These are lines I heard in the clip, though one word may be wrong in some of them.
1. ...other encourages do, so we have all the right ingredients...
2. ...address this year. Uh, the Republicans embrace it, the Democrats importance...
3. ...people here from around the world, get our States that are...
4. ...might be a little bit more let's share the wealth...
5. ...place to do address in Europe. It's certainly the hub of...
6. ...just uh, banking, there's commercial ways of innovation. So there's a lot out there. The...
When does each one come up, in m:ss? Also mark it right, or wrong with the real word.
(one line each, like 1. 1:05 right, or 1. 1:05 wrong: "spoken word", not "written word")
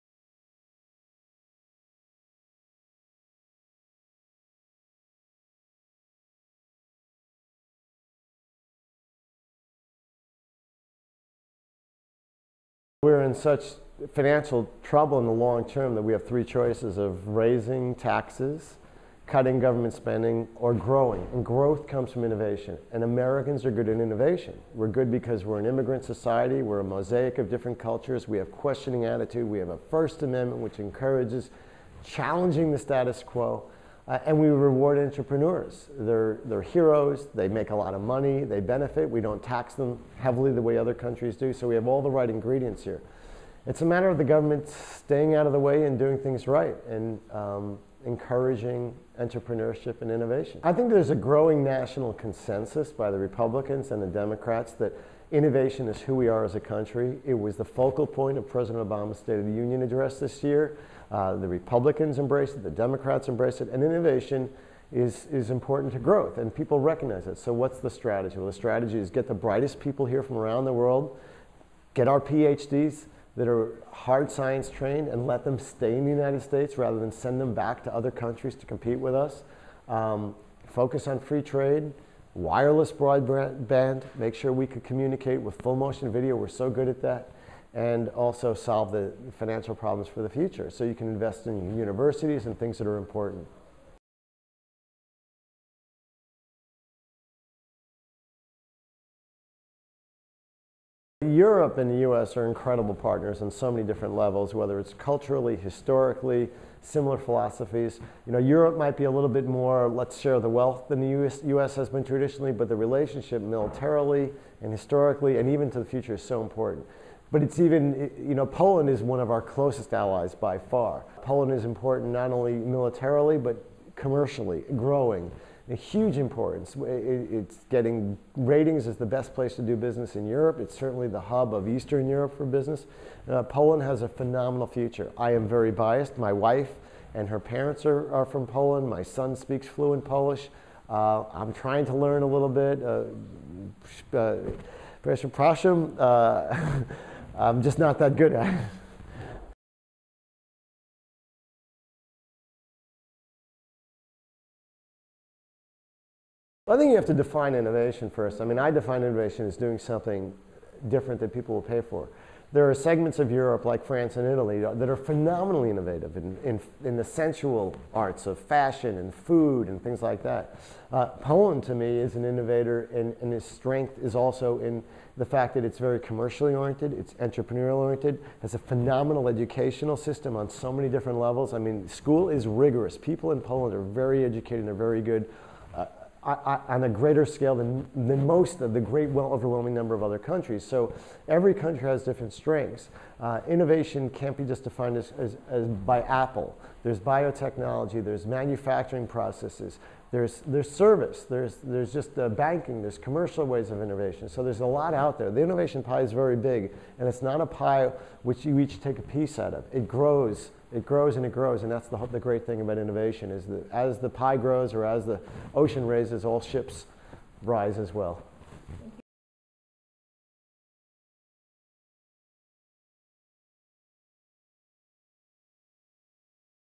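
1. 0:40 wrong: "countries", not "encourages"
2. 0:59 wrong: "embrace", not "importance"
3. 1:09 wrong: "PhDs", not "States"
4. 1:48 right
5. 2:09 wrong: "business", not "address"
6. 3:21 right.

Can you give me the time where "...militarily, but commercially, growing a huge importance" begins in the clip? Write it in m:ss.
2:02.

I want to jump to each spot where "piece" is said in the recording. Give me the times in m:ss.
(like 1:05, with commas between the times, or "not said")
3:29.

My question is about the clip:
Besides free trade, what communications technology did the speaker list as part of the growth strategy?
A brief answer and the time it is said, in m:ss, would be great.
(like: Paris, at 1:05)
wireless broadband, at 1:22.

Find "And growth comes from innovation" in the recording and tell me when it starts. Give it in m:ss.
0:21.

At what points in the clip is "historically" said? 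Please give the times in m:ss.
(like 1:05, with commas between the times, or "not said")
1:45, 1:54.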